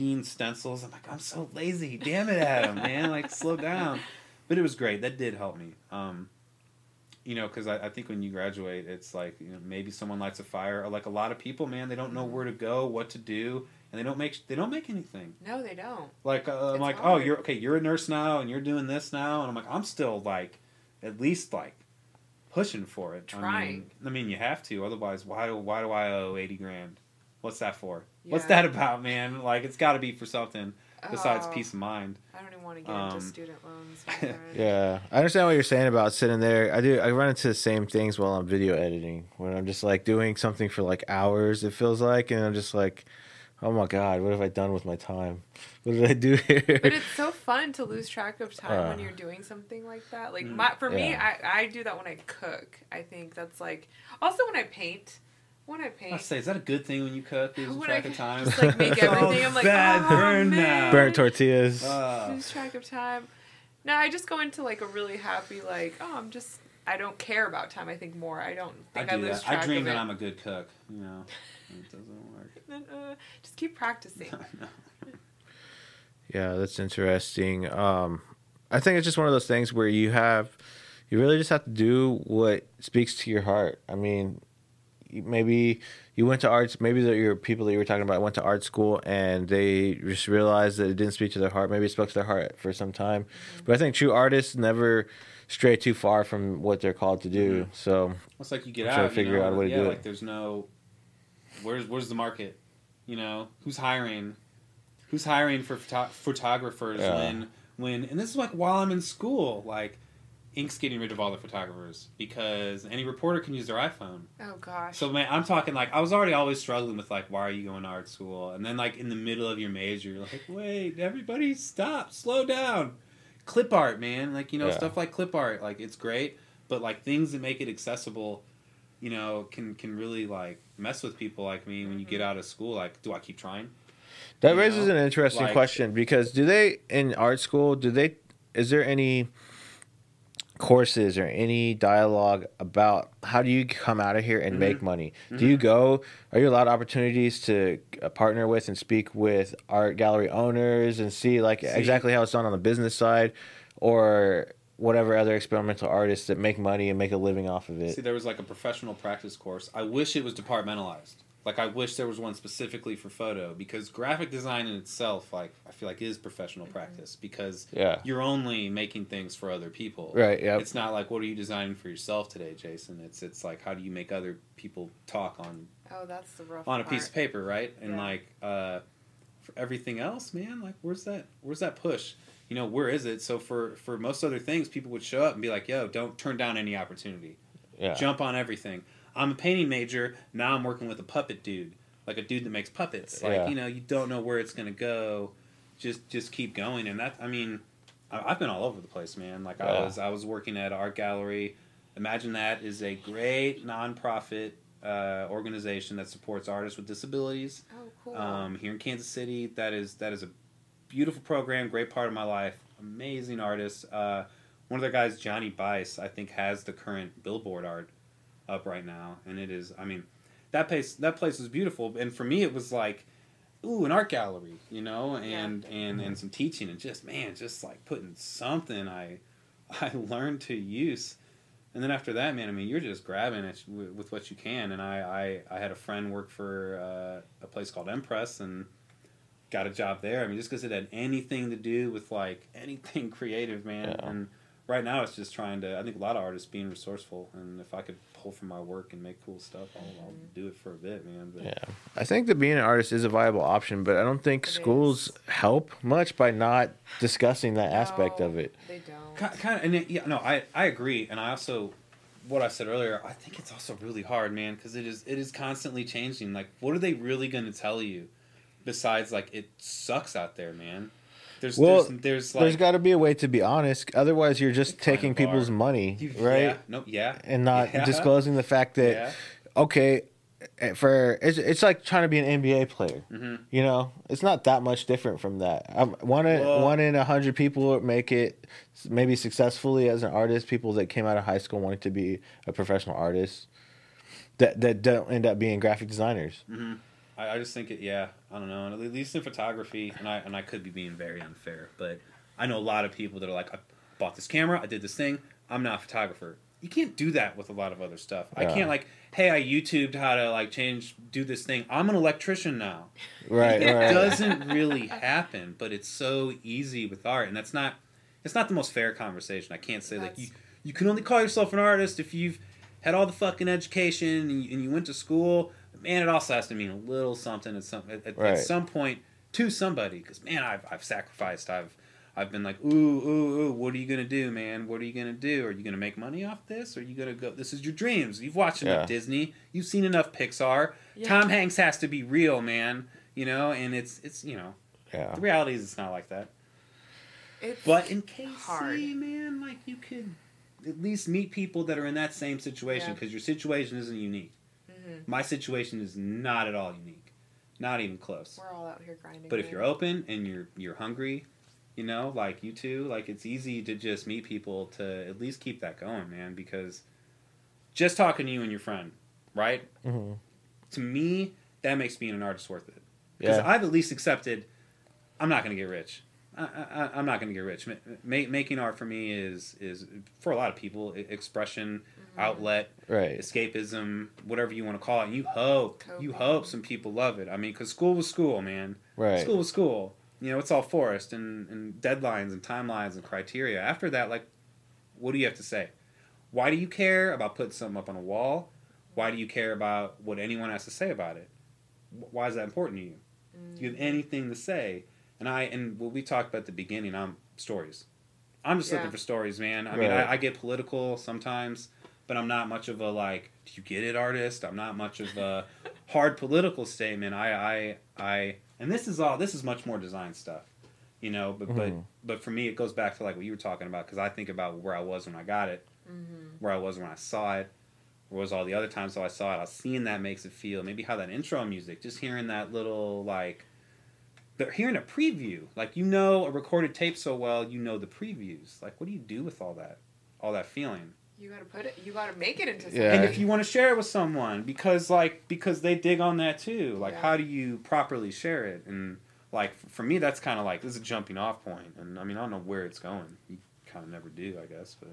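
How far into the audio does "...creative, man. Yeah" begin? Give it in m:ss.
4:03.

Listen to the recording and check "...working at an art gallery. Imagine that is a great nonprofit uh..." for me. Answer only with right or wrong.
right.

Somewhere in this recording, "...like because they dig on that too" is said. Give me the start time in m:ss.
7:24.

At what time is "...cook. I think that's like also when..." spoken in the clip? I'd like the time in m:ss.
0:52.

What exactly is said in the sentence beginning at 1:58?
And then like in the middle of your major, you're like, wait, everybody stop, slow down.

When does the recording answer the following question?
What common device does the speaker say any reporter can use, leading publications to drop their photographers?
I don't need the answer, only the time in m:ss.
1:53.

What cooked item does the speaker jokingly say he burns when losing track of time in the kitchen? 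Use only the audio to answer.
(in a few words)
Tortillas.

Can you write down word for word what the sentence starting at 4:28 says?
besides like it sucks out there, man.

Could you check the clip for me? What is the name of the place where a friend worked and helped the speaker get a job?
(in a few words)
Empress.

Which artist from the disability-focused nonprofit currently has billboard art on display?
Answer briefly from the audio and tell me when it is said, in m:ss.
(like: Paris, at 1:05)
Johnny Bice, at 3:35.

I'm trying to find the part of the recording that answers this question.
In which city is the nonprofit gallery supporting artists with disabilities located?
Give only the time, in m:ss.
3:28.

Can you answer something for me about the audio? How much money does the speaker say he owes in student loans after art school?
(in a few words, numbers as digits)
80 grand.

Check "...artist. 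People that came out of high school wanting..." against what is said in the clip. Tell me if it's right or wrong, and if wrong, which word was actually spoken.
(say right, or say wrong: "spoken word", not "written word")
right.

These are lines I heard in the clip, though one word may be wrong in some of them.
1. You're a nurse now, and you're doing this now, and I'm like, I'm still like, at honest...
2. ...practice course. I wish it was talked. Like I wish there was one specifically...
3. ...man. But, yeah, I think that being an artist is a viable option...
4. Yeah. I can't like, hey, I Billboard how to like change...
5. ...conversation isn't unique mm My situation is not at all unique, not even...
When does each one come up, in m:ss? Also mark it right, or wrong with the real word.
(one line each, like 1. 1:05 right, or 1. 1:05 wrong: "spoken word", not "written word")
1. 0:17 wrong: "least", not "honest"
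2. 2:38 wrong: "departmentalized", not "talked"
3. 4:11 right
4. 5:08 wrong: "YouTubed", not "Billboard"
5. 5:53 wrong: "situation", not "conversation".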